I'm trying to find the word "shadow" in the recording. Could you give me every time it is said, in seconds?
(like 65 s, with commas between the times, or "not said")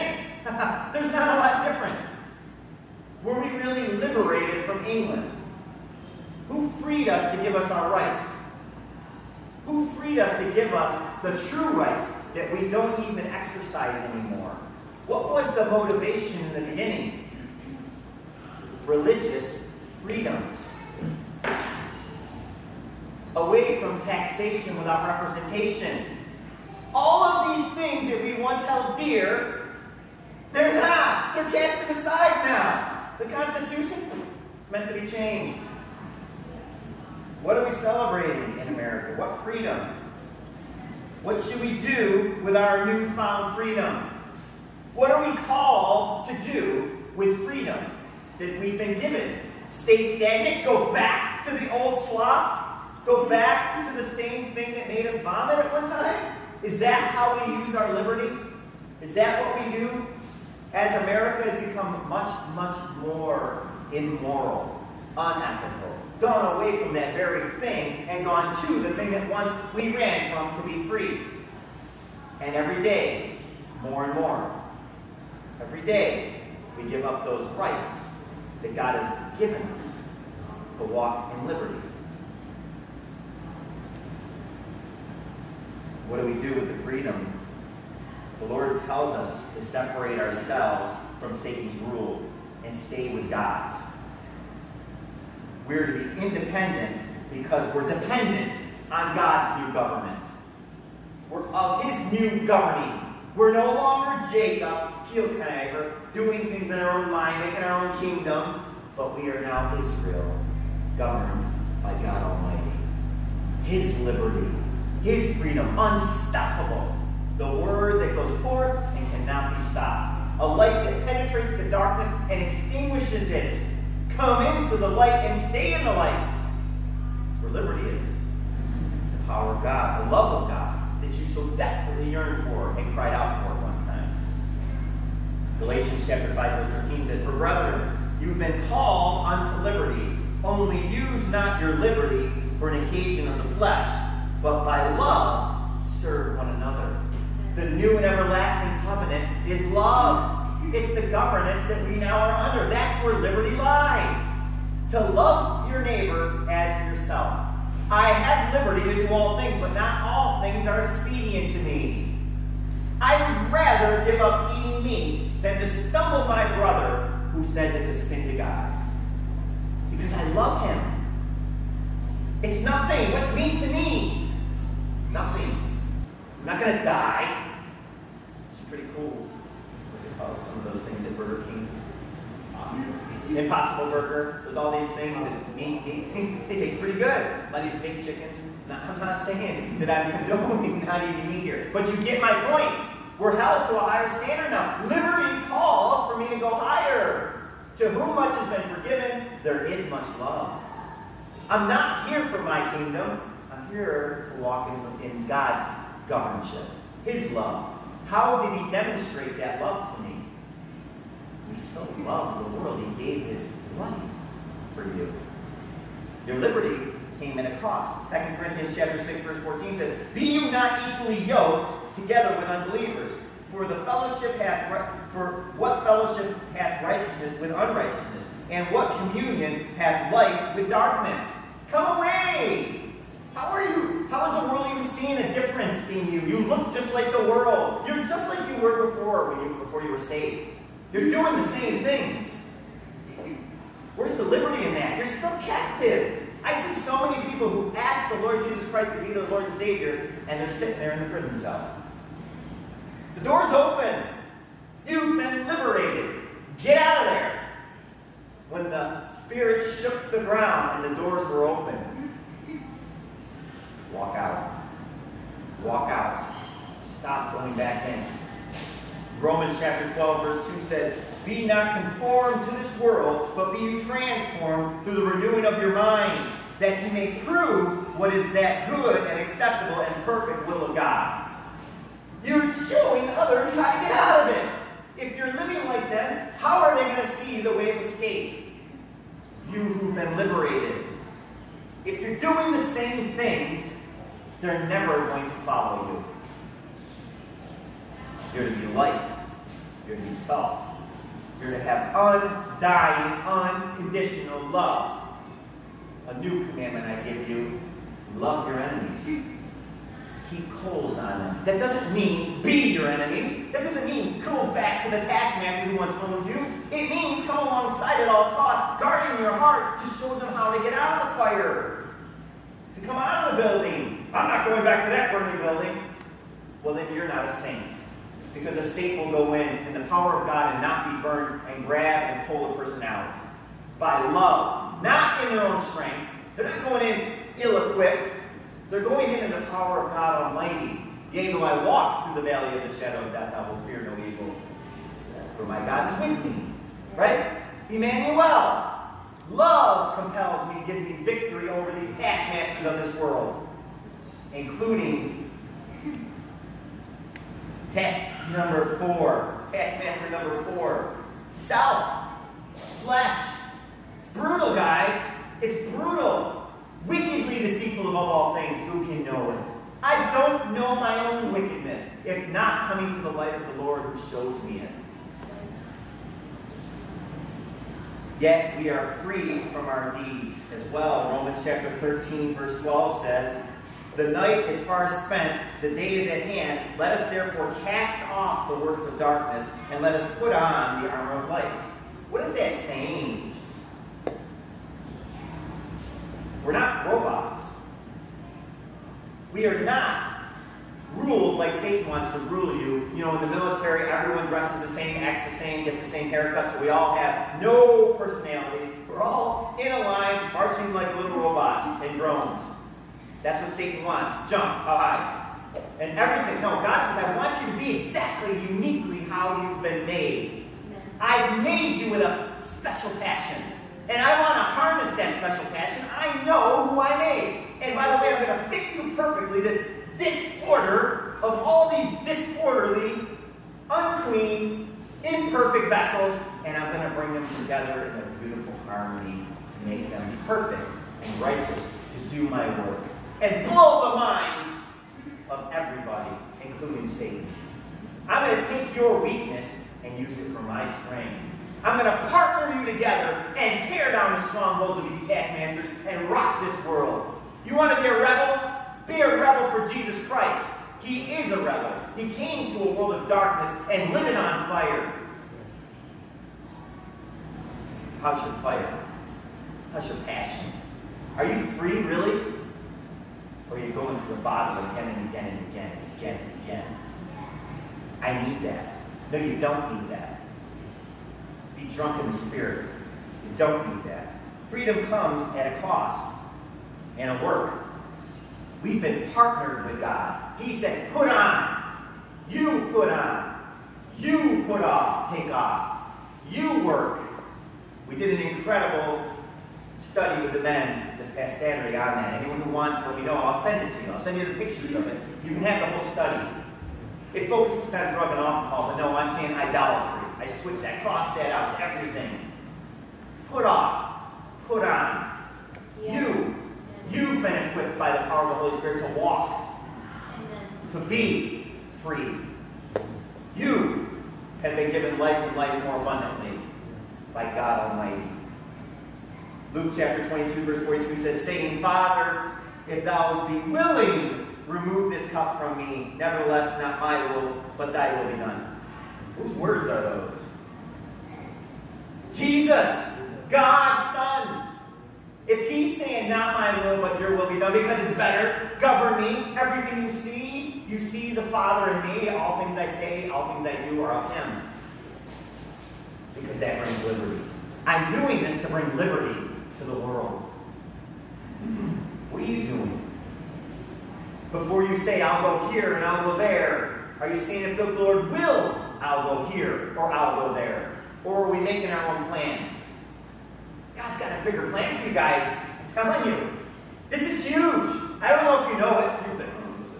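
342 s.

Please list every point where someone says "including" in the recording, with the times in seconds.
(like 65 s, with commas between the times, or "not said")
354 s, 446 s.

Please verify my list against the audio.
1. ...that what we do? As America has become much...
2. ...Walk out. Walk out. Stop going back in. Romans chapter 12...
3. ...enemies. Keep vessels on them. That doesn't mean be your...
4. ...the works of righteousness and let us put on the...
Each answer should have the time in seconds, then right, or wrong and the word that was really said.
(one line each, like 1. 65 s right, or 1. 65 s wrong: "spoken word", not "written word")
1. 59 s right
2. 263 s right
3. 308 s wrong: "coals", not "vessels"
4. 388 s wrong: "darkness", not "righteousness".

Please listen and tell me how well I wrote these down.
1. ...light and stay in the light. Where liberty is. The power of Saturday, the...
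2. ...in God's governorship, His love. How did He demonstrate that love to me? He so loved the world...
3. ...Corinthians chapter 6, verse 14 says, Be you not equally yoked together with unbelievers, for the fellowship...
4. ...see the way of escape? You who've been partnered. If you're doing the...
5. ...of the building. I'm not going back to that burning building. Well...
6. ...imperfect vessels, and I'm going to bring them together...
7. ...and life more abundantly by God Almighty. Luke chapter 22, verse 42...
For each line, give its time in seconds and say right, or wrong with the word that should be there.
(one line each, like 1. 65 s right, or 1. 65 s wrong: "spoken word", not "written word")
1. 124 s wrong: "God", not "Saturday"
2. 205 s right
3. 218 s right
4. 287 s wrong: "liberated", not "partnered"
5. 323 s right
6. 435 s right
7. 525 s right.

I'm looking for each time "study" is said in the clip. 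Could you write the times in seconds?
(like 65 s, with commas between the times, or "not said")
499 s, 505 s.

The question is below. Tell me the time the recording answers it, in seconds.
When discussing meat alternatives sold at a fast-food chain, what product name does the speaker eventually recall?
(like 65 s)
183 s.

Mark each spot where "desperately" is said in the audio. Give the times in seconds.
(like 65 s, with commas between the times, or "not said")
131 s.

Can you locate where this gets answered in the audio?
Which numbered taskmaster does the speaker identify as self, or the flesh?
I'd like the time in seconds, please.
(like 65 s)
359 s.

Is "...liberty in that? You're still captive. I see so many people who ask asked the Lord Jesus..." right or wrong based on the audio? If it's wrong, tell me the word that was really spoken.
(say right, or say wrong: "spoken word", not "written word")
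right.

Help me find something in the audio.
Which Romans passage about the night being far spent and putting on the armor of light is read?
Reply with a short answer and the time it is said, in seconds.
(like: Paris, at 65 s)
Romans 13:12, at 381 s.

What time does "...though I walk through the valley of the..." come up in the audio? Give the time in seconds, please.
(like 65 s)
341 s.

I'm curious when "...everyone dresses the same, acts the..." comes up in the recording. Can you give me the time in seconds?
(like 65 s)
403 s.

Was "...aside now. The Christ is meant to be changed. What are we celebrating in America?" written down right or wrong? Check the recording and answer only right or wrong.
wrong.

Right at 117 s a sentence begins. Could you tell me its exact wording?
The word that goes forth and cannot be stopped.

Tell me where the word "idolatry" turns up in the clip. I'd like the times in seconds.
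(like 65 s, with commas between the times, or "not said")
509 s.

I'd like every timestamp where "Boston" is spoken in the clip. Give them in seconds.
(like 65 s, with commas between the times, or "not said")
not said.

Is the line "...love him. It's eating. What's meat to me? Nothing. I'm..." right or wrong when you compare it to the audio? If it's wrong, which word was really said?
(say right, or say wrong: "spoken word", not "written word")
wrong: "nothing", not "eating".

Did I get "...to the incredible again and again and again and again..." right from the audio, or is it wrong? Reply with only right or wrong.
wrong.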